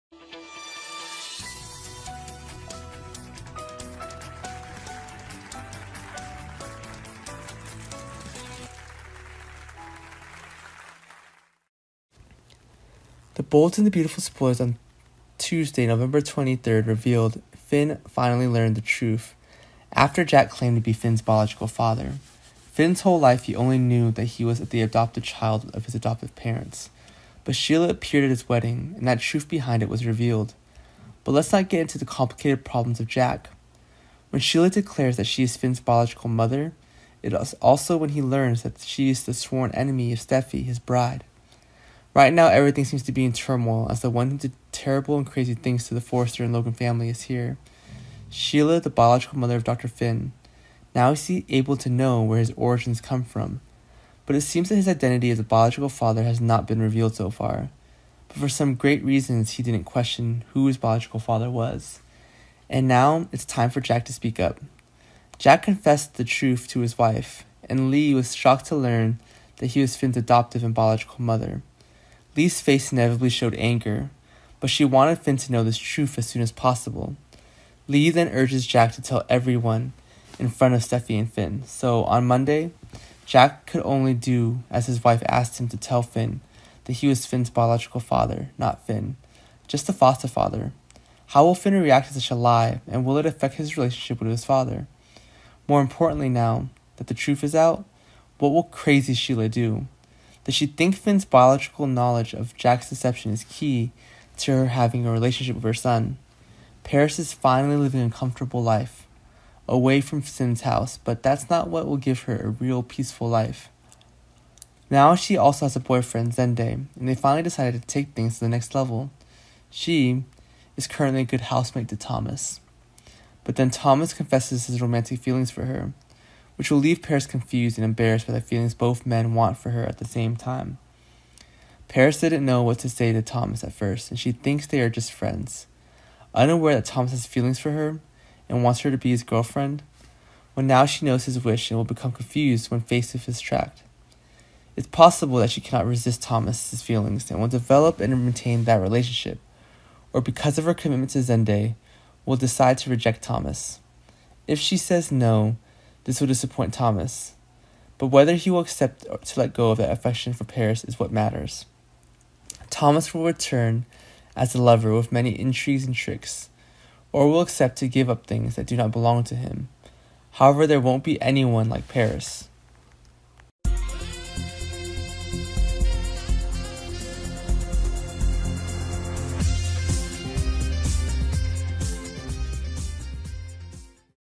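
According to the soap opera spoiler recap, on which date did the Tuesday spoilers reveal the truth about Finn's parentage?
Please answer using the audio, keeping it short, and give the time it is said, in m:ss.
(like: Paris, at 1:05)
November 23rd, at 0:15.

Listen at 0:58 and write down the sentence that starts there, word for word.
But for some great reasons, he didn't question who his biological father was.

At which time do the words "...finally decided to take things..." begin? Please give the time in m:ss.
1:57.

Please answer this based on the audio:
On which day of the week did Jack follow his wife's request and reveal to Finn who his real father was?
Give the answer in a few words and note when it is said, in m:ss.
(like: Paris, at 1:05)
Monday, at 1:22.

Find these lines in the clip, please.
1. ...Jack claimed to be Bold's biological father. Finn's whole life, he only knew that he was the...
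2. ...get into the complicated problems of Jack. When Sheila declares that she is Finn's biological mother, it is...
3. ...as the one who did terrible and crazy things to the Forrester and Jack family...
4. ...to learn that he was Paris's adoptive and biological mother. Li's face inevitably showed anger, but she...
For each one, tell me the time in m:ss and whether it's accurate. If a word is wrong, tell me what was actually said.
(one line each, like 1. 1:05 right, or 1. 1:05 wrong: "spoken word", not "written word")
1. 0:20 wrong: "Finn", not "Bold"
2. 0:31 right
3. 0:43 wrong: "Logan", not "Jack"
4. 1:08 wrong: "Finn", not "Paris".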